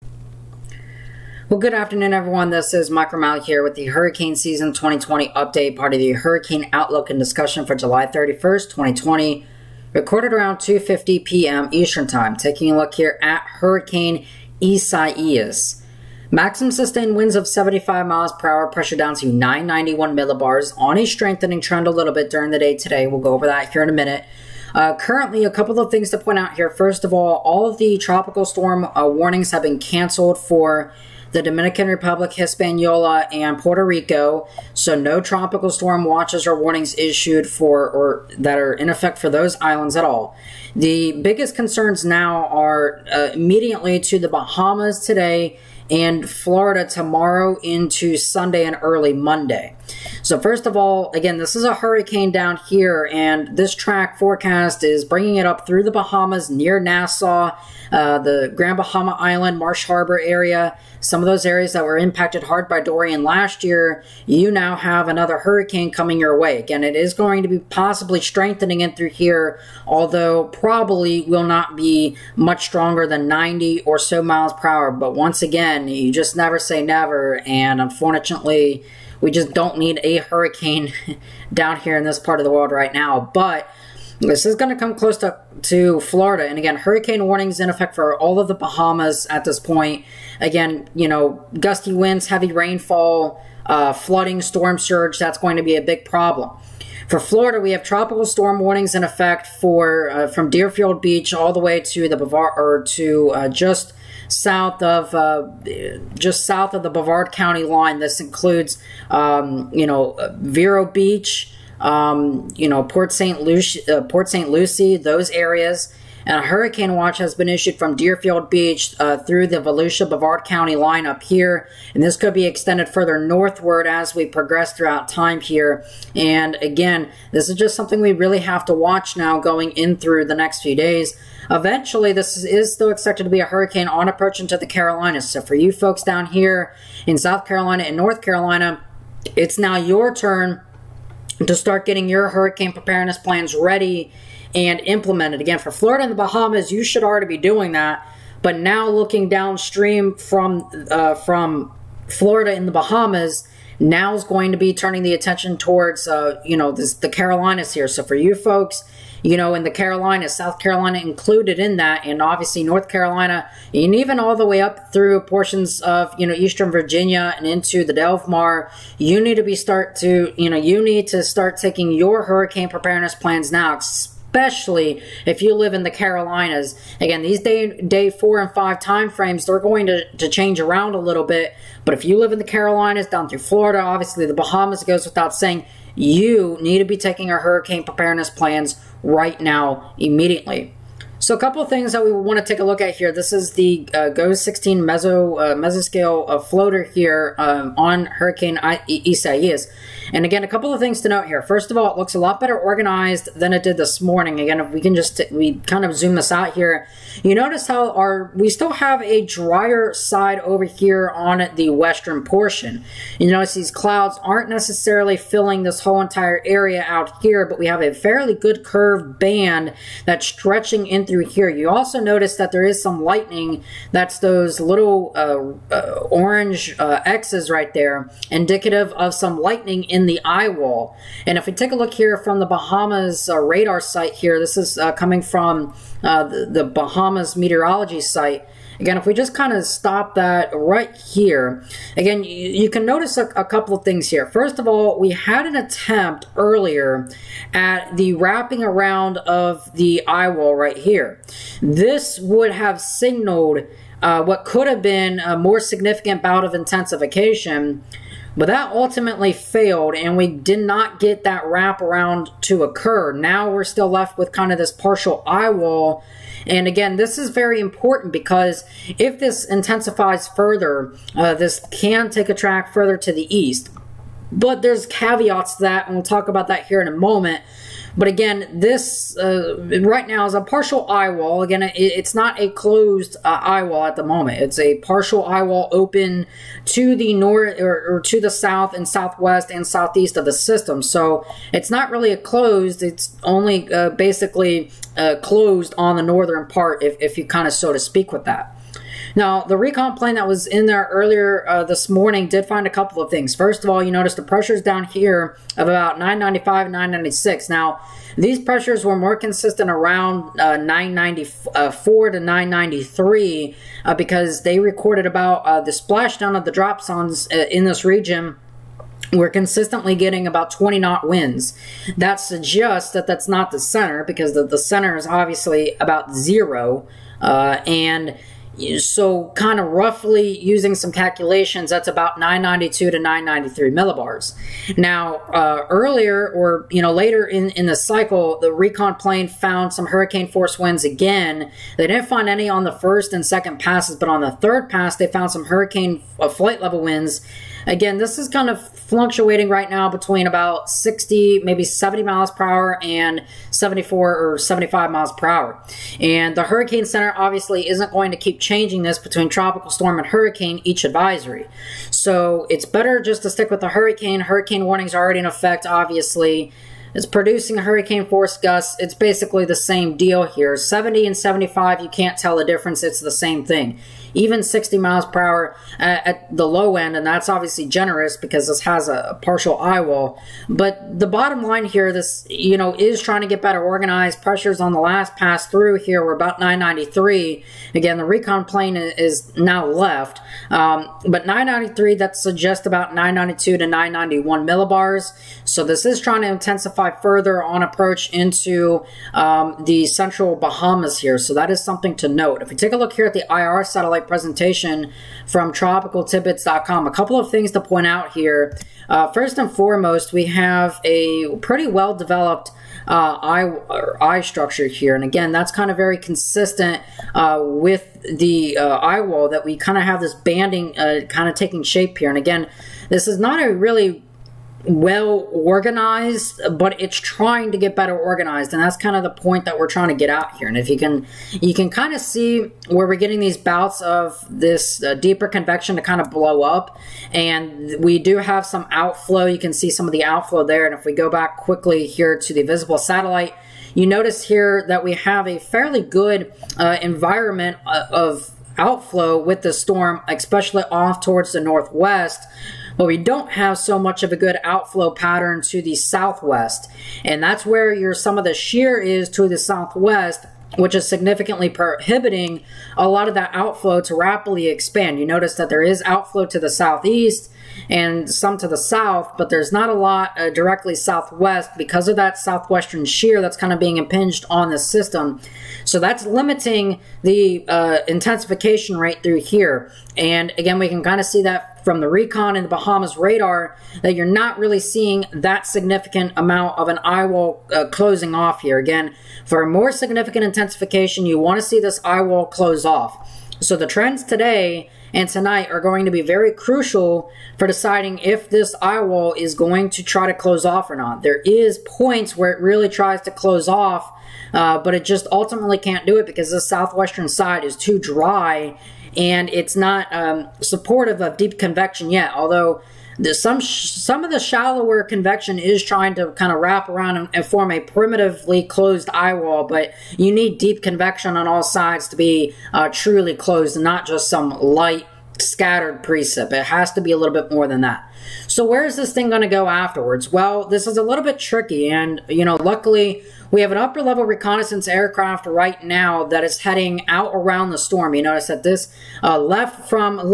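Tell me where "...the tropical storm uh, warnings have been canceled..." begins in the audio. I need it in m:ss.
0:27.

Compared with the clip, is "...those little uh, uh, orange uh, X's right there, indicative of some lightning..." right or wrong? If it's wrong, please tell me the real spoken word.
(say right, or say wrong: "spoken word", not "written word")
right.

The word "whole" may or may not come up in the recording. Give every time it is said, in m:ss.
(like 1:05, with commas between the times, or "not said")
3:35.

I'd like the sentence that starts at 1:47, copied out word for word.
This includes, um, you know, Vero Beach, um, you know, Port St.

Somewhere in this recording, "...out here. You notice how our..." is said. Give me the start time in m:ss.
3:26.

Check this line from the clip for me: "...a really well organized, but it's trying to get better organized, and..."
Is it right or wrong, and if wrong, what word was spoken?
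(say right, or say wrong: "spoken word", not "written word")
right.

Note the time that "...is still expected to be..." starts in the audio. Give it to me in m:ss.
2:12.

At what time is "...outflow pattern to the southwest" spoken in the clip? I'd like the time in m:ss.
7:34.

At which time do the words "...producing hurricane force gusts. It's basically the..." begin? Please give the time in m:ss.
6:07.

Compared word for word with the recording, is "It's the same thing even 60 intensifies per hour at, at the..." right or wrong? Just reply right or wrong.
wrong.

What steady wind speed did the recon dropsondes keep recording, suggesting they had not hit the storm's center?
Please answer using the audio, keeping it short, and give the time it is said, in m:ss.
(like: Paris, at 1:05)
20 knots, at 5:20.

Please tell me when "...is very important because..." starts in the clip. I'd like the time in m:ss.
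4:27.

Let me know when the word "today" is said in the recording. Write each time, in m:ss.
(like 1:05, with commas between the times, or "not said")
0:22, 0:45, 8:14.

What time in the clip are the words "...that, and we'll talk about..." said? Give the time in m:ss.
4:35.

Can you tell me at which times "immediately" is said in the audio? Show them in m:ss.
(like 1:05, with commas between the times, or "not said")
0:43, 3:09.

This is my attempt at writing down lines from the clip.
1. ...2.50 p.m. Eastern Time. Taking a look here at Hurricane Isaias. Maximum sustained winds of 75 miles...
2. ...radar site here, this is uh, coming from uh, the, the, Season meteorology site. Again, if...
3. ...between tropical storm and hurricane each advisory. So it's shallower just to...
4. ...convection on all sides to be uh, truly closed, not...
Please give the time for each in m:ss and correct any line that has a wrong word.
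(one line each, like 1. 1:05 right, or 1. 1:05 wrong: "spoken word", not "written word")
1. 0:10 right
2. 3:53 wrong: "Bahamas", not "Season"
3. 5:58 wrong: "better", not "shallower"
4. 8:40 right.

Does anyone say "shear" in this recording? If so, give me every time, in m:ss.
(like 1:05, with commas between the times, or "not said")
7:38, 7:52.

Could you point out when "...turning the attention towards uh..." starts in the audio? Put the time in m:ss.
2:34.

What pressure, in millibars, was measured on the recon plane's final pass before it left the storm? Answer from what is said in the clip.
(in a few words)
993.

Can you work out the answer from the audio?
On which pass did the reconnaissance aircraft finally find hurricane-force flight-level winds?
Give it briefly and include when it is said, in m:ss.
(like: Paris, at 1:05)
third pass, at 5:44.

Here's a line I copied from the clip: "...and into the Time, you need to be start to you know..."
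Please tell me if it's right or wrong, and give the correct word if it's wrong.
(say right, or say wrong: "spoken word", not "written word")
wrong: "Delmar", not "Time".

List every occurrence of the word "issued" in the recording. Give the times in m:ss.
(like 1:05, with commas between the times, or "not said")
0:36, 1:57.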